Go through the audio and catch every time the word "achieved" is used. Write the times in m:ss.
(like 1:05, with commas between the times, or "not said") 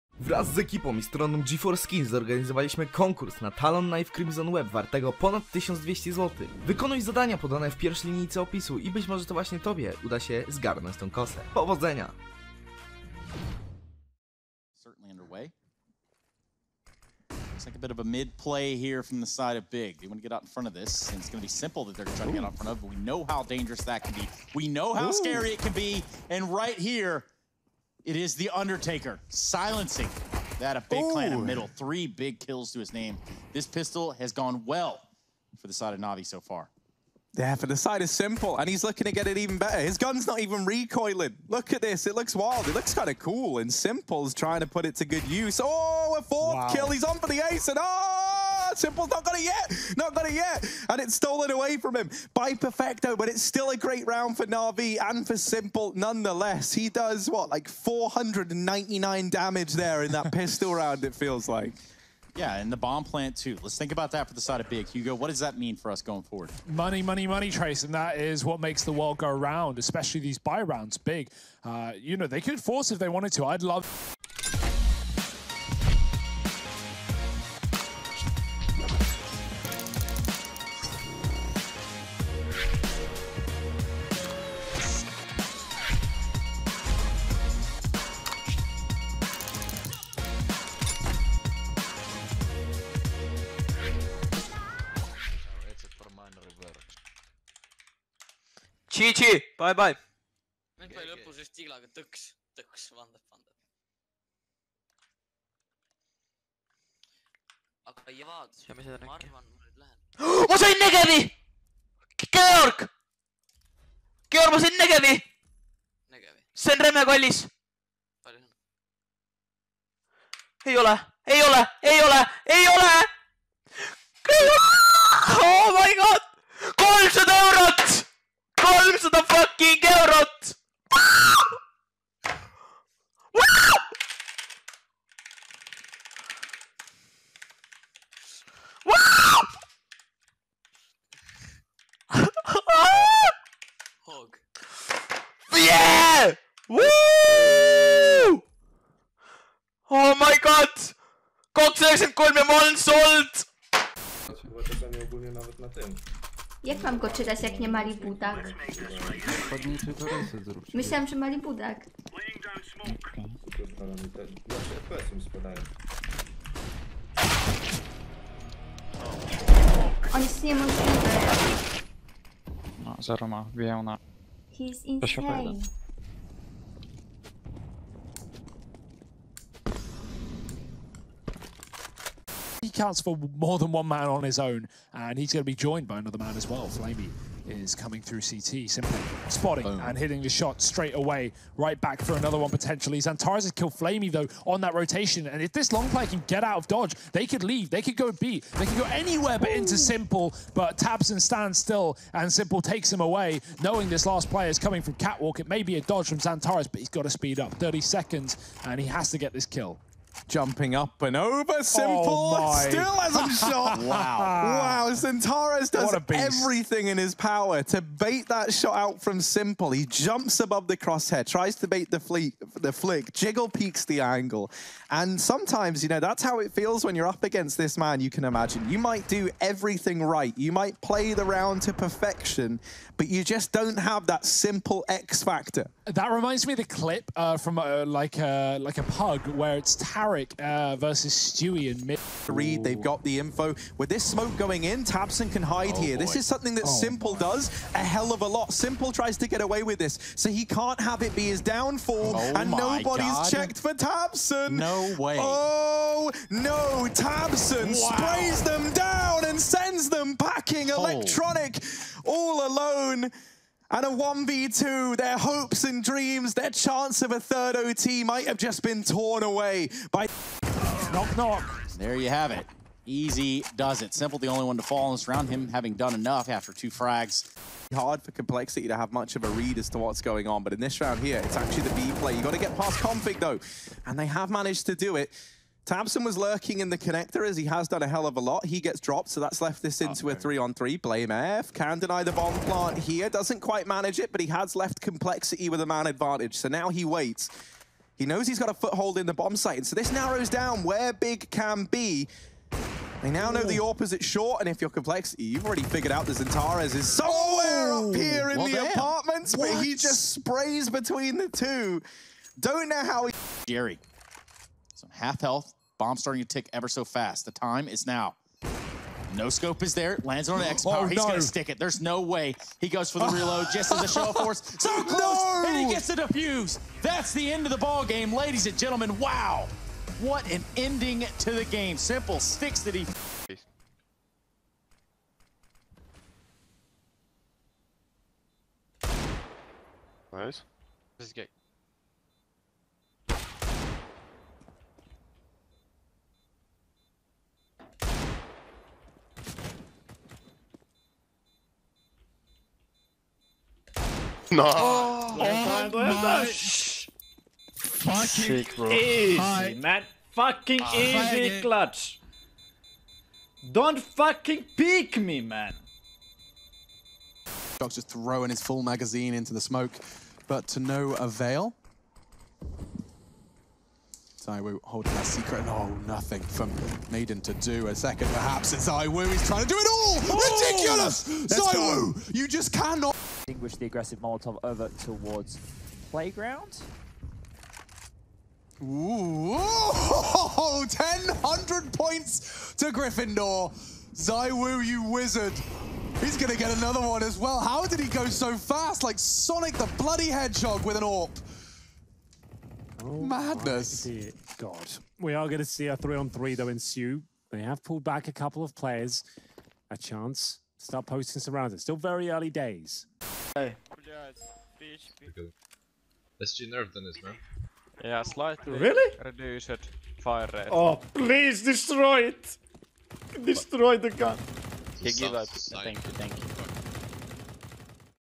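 not said.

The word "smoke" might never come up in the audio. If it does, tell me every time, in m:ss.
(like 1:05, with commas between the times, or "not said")
4:04, 6:09.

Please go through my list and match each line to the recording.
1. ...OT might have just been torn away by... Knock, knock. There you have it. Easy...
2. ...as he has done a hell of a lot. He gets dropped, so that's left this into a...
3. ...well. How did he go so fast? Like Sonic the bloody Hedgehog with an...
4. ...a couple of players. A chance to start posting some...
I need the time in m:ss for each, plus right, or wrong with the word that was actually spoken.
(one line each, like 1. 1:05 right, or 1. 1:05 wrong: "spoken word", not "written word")
1. 4:27 right
2. 4:47 right
3. 6:37 right
4. 6:48 right.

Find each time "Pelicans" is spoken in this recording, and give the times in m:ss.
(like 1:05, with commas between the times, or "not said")
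not said.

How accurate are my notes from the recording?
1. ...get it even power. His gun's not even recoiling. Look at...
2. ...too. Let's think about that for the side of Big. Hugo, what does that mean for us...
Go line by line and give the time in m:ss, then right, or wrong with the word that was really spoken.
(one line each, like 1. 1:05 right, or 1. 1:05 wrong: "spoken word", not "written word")
1. 0:39 wrong: "better", not "power"
2. 1:03 right.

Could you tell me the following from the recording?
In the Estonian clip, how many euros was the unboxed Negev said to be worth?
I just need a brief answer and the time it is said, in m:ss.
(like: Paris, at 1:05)
300 euros, at 2:06.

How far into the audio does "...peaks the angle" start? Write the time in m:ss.
3:43.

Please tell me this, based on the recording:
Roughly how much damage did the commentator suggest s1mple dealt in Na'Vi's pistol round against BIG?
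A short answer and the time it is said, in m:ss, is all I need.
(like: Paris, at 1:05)
499, at 0:57.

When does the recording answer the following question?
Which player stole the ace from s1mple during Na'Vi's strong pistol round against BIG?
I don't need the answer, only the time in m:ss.
0:52.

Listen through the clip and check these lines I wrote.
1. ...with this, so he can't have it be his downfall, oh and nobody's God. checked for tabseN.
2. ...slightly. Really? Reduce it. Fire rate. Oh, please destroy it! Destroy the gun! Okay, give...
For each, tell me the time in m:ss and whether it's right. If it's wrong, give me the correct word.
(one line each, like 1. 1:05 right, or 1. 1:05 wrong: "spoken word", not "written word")
1. 4:09 right
2. 6:58 right.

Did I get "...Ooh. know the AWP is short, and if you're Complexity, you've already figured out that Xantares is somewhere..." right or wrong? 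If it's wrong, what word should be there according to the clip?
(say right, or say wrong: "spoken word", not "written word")
right.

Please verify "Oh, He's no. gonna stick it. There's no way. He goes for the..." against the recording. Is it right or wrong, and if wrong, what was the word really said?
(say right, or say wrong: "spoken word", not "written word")
right.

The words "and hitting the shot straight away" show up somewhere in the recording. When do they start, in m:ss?
3:09.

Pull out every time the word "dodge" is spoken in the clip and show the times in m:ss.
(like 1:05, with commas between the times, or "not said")
3:16, 3:25.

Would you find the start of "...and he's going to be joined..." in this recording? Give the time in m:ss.
3:04.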